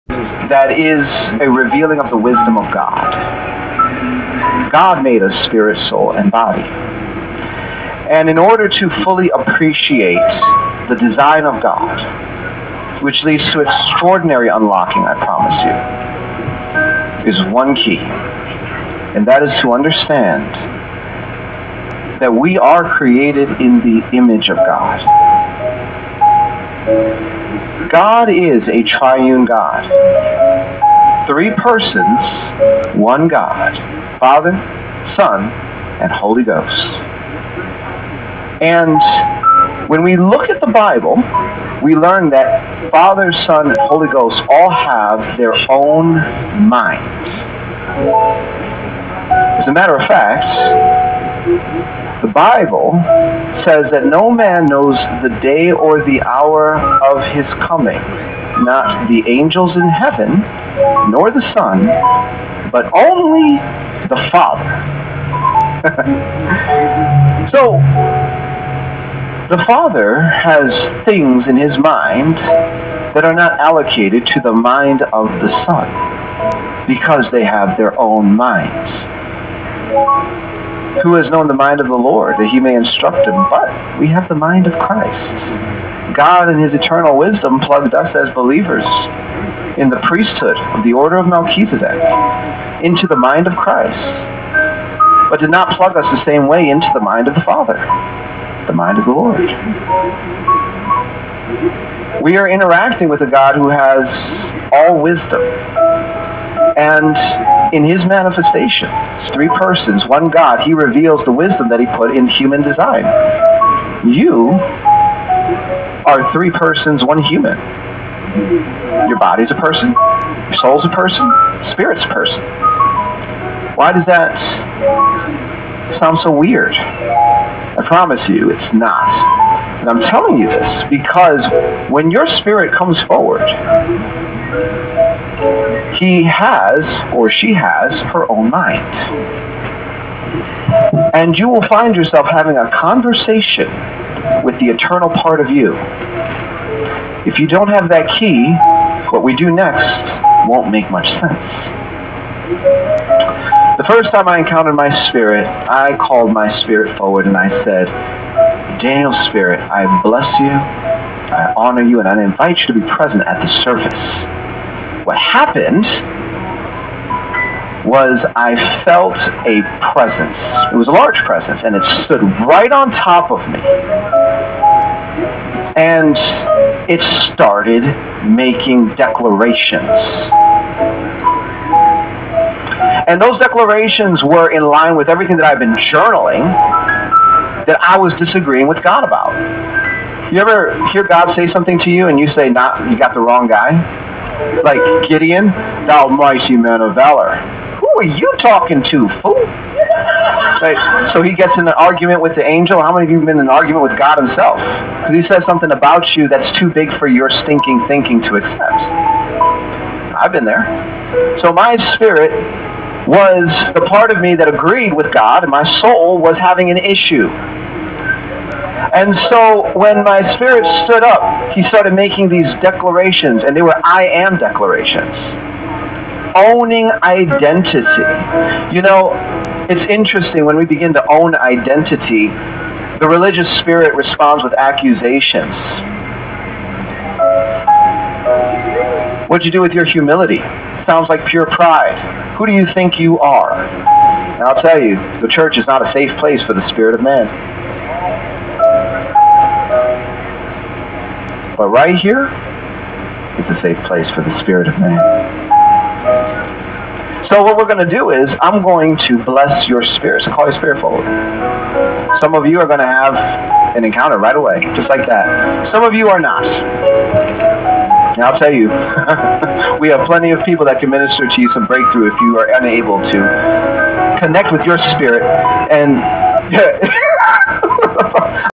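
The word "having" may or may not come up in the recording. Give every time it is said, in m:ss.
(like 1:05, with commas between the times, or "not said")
2:22, 3:36.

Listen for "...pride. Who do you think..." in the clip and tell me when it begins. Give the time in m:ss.
4:01.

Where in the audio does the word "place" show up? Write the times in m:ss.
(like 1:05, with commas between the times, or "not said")
4:06, 4:13.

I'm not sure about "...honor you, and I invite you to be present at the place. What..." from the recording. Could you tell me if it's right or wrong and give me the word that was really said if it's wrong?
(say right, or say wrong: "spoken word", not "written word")
wrong: "service", not "place".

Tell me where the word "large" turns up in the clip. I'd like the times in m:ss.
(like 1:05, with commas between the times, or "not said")
2:50.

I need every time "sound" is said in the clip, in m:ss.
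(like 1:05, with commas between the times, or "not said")
2:06, 4:00.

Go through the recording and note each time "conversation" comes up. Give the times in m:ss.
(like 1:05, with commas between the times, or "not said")
2:22.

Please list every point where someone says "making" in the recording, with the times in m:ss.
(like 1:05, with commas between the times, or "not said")
2:58, 3:41.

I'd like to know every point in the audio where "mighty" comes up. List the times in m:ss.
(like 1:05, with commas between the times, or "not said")
3:16.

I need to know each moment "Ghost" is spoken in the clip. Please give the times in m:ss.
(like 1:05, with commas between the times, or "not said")
0:36, 0:44.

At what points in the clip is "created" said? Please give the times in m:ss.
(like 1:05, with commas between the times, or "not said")
0:22.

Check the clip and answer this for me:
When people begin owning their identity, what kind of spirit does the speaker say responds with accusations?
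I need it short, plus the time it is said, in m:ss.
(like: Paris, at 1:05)
The religious spirit, at 3:52.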